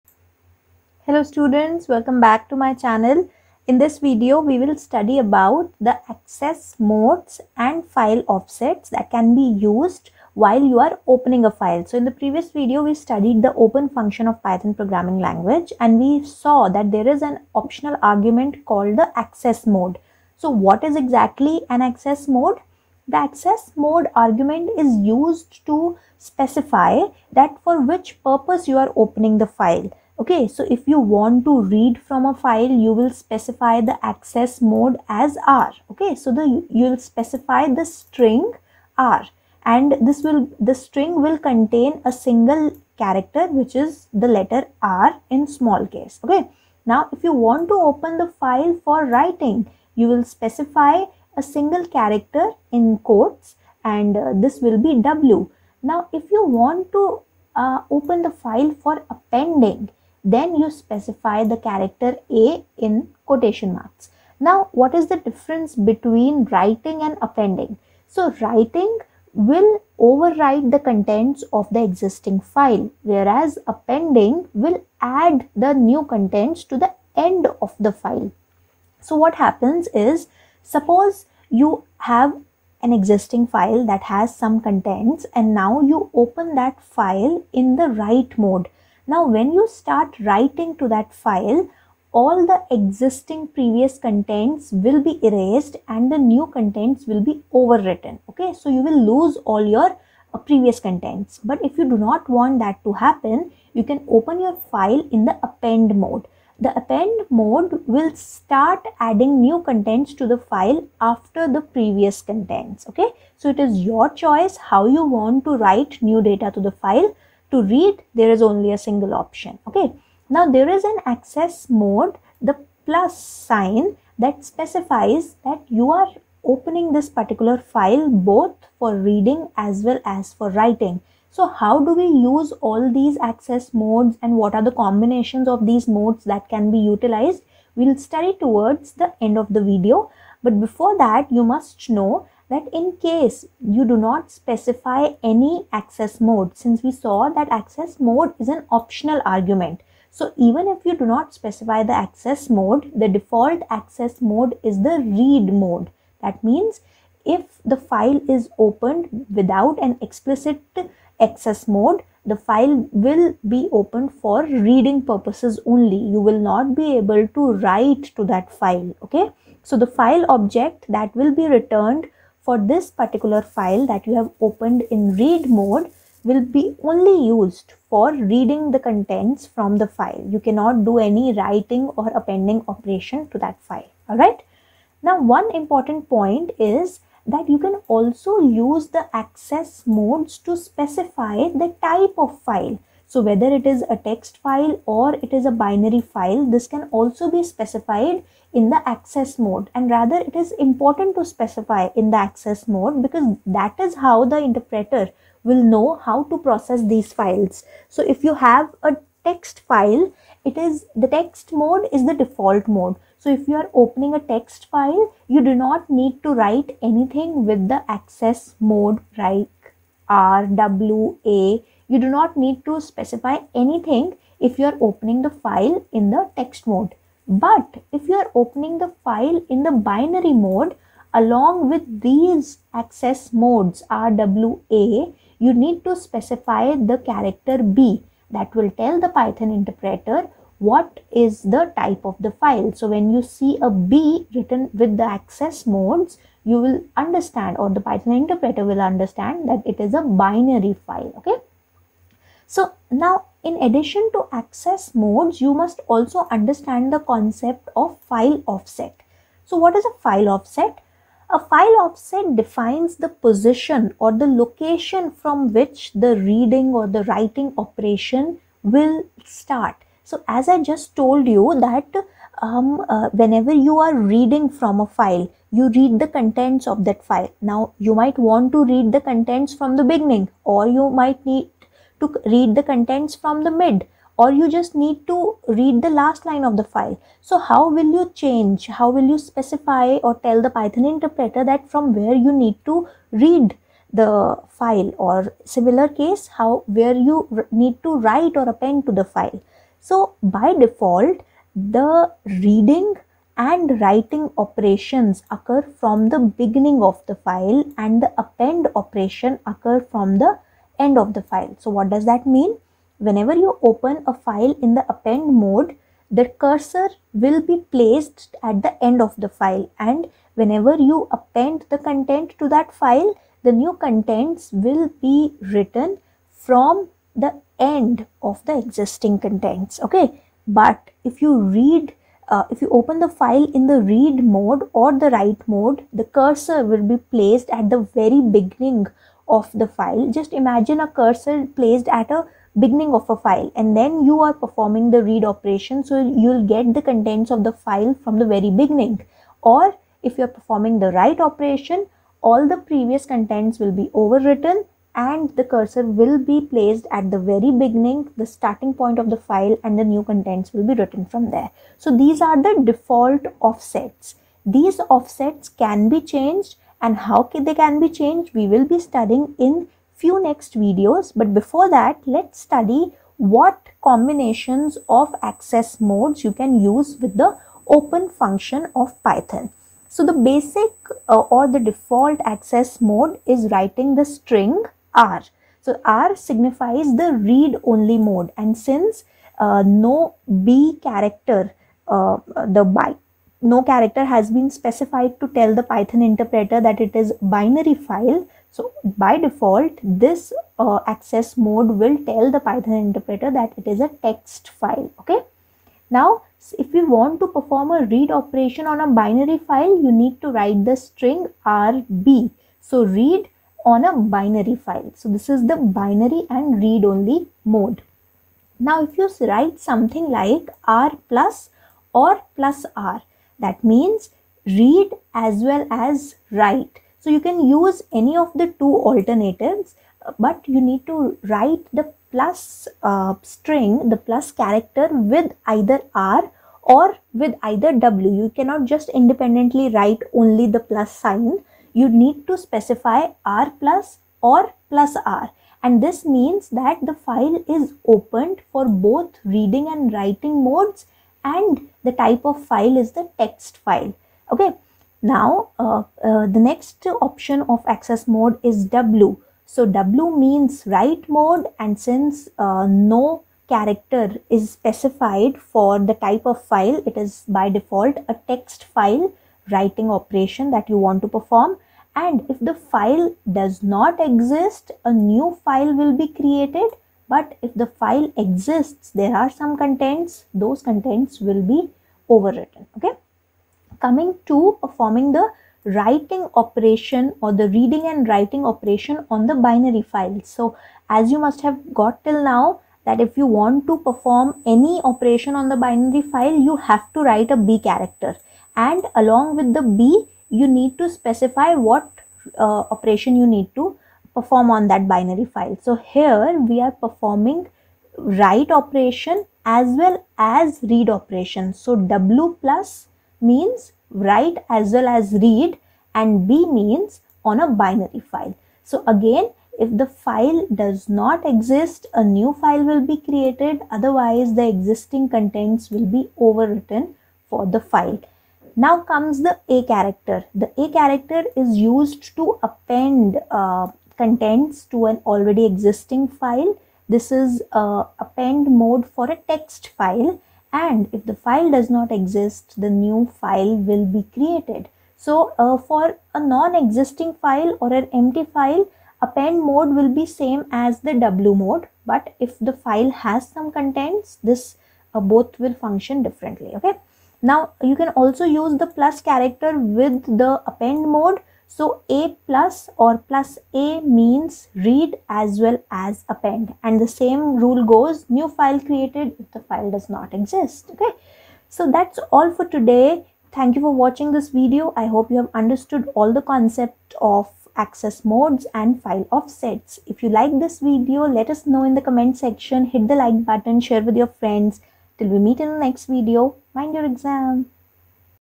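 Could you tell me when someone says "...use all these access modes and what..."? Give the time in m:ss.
2:12.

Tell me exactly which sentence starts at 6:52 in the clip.
So read on a binary file.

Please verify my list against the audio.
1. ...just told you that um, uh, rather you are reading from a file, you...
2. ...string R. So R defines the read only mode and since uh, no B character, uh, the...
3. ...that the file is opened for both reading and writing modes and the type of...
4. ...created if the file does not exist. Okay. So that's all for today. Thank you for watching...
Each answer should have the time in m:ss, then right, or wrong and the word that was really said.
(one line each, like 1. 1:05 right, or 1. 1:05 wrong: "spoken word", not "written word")
1. 4:30 wrong: "whenever", not "rather"
2. 6:24 wrong: "signifies", not "defines"
3. 7:26 right
4. 9:28 right.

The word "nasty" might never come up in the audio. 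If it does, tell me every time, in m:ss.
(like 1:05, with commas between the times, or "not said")
not said.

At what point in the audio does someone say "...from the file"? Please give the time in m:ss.
2:59.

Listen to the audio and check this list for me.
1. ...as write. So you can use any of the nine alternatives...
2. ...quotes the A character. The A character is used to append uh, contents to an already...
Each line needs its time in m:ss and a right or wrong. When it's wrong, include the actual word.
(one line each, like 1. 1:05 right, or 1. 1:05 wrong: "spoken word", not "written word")
1. 7:05 wrong: "two", not "nine"
2. 8:48 wrong: "comes", not "quotes".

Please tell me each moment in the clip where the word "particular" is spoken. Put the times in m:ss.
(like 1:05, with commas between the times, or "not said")
2:07, 2:52.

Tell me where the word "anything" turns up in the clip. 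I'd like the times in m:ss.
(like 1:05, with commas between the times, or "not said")
3:36, 3:43.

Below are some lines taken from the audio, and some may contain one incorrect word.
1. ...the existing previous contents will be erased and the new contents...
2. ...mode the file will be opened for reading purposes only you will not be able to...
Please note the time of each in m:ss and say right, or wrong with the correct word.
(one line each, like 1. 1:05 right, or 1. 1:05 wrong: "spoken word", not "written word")
1. 1:32 right
2. 2:41 right.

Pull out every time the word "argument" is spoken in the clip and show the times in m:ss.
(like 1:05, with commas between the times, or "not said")
0:18, 0:24, 2:29.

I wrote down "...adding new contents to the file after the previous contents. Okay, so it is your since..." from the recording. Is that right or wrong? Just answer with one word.
wrong.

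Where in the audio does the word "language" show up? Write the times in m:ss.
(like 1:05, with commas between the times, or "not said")
0:15.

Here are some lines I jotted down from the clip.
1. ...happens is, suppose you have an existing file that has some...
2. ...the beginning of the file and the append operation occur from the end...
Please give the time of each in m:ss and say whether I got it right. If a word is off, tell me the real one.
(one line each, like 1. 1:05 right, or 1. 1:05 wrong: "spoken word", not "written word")
1. 1:19 right
2. 5:06 right.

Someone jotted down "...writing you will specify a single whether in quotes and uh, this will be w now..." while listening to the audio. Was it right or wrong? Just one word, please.
wrong.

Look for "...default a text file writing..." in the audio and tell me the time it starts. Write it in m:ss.
7:47.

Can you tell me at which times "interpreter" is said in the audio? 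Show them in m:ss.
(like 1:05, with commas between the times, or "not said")
3:24, 3:59, 4:08, 4:50, 6:36, 6:42.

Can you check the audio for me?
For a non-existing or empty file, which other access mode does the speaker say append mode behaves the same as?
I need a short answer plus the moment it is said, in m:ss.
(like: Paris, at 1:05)
w mode, at 9:10.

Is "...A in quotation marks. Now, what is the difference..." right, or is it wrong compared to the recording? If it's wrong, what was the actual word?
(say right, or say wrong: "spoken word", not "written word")
right.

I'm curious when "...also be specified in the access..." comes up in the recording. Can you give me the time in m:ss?
3:16.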